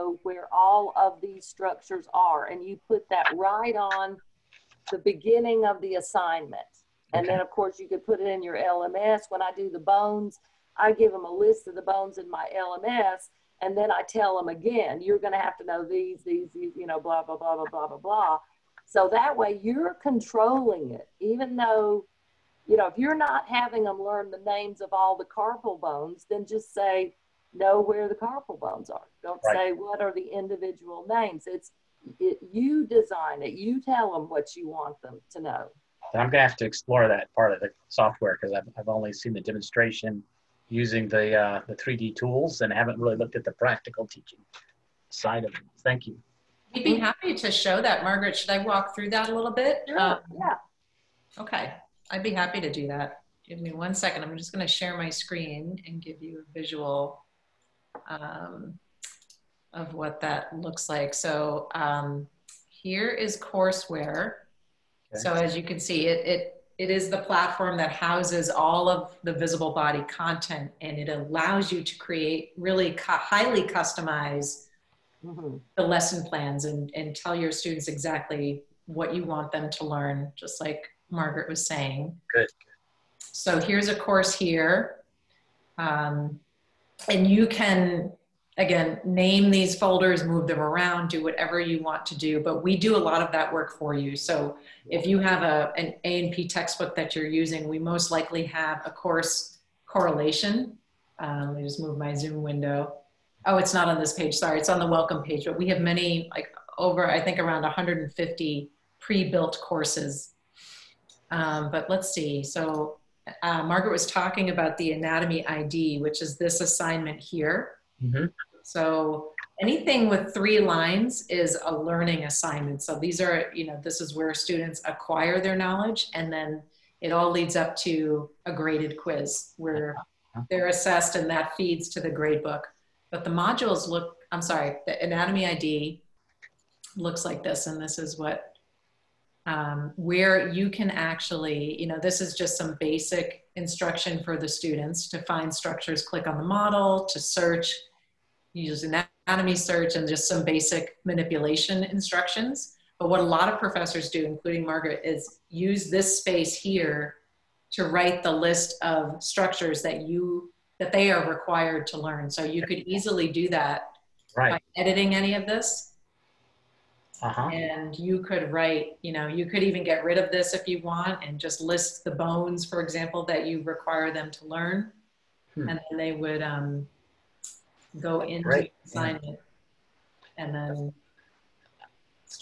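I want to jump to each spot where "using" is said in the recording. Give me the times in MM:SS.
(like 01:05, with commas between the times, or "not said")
00:40, 01:37.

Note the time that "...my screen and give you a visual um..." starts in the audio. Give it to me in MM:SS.
00:54.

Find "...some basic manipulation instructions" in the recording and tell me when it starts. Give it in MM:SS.
02:30.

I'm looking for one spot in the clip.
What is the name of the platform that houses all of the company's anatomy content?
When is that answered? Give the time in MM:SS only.
01:03.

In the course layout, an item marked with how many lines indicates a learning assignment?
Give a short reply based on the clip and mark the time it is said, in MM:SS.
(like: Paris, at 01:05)
3, at 02:00.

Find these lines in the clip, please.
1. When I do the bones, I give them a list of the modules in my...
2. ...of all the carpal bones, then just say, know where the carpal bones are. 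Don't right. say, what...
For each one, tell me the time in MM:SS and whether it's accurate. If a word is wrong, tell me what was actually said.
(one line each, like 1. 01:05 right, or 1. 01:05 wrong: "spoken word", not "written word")
1. 00:09 wrong: "bones", not "modules"
2. 00:24 right.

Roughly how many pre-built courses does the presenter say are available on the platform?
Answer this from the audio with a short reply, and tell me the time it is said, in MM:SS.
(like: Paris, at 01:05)
150, at 01:47.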